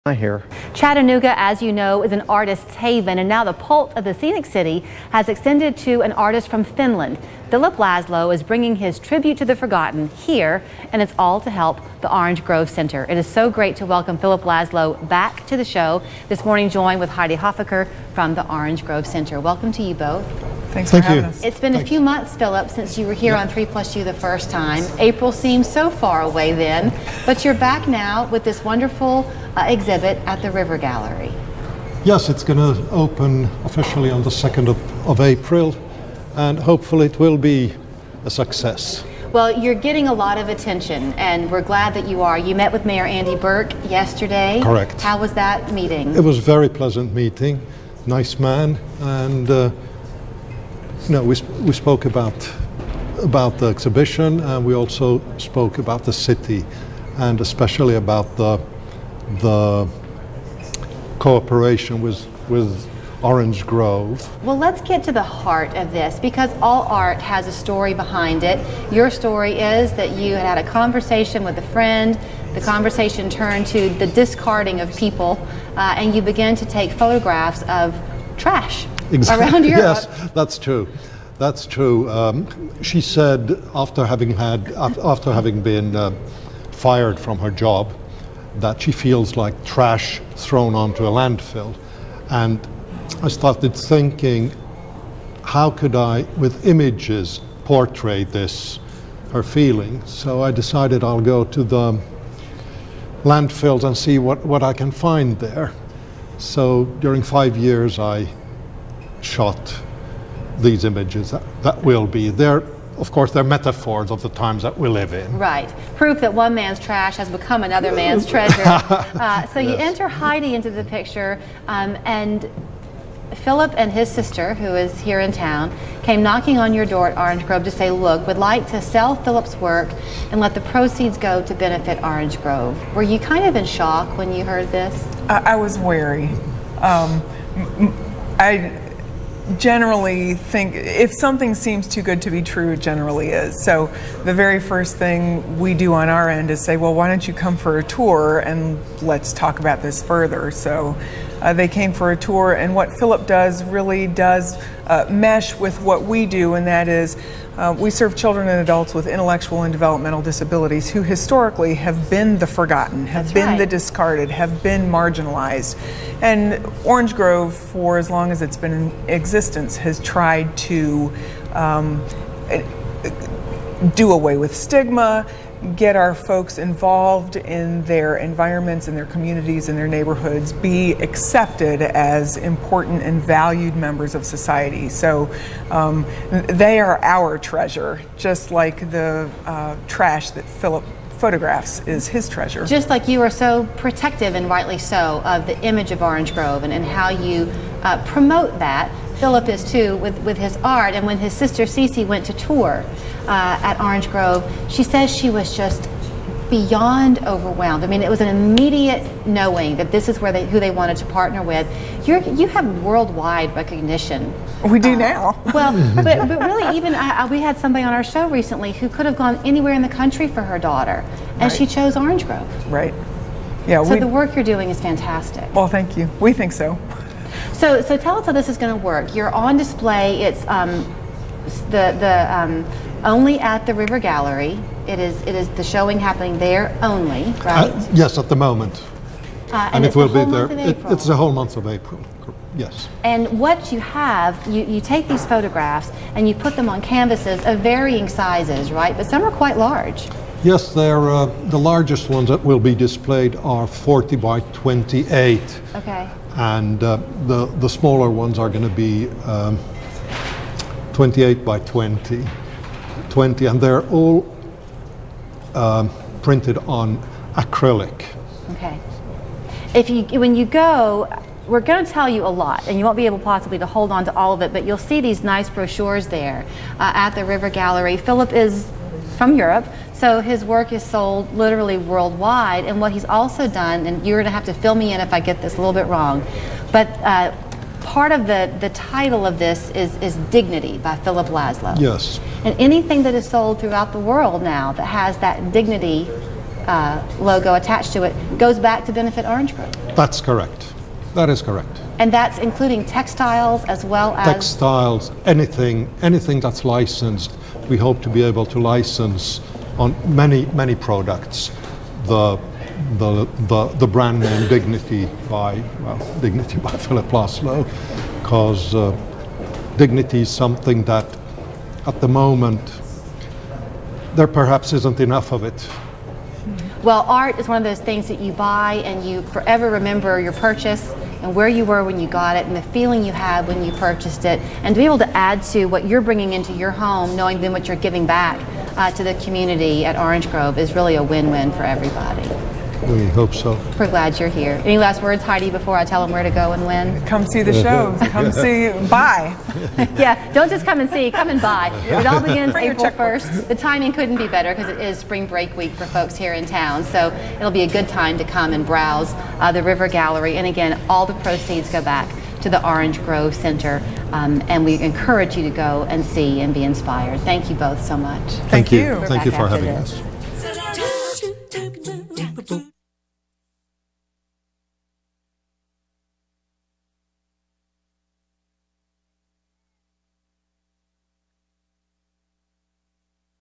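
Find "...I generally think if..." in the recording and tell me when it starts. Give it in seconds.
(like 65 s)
138 s.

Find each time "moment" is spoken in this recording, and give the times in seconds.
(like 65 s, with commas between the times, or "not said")
238 s, 322 s.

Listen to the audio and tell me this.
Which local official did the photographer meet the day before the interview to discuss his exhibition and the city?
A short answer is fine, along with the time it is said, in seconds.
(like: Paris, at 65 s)
Andy Berke, at 43 s.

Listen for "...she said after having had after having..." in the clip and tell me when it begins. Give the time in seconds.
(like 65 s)
82 s.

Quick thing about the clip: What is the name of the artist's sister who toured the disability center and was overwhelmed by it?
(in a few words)
Cece.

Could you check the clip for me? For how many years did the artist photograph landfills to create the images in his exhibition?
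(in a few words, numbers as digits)
5.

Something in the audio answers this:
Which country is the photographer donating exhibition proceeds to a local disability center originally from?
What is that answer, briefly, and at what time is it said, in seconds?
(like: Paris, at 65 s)
Finland, at 6 s.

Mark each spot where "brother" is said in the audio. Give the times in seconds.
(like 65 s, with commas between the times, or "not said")
not said.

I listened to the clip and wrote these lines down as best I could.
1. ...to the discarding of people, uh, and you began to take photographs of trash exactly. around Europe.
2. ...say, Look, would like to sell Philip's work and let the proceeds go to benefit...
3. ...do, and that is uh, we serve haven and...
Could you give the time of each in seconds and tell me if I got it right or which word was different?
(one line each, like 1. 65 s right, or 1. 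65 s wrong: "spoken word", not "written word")
1. 73 s right
2. 127 s right
3. 156 s wrong: "children", not "haven".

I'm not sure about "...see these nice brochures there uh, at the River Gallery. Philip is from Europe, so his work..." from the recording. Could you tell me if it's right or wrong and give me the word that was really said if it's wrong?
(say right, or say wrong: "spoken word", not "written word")
right.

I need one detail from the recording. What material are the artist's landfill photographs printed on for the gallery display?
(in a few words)
Acrylic.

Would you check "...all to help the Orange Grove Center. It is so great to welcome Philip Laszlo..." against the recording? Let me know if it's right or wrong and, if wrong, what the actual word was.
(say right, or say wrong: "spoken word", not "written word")
right.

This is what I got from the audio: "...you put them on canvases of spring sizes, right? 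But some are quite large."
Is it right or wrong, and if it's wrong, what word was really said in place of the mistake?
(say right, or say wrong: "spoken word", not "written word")
wrong: "varying", not "spring".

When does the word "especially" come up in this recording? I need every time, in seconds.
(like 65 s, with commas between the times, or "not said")
57 s.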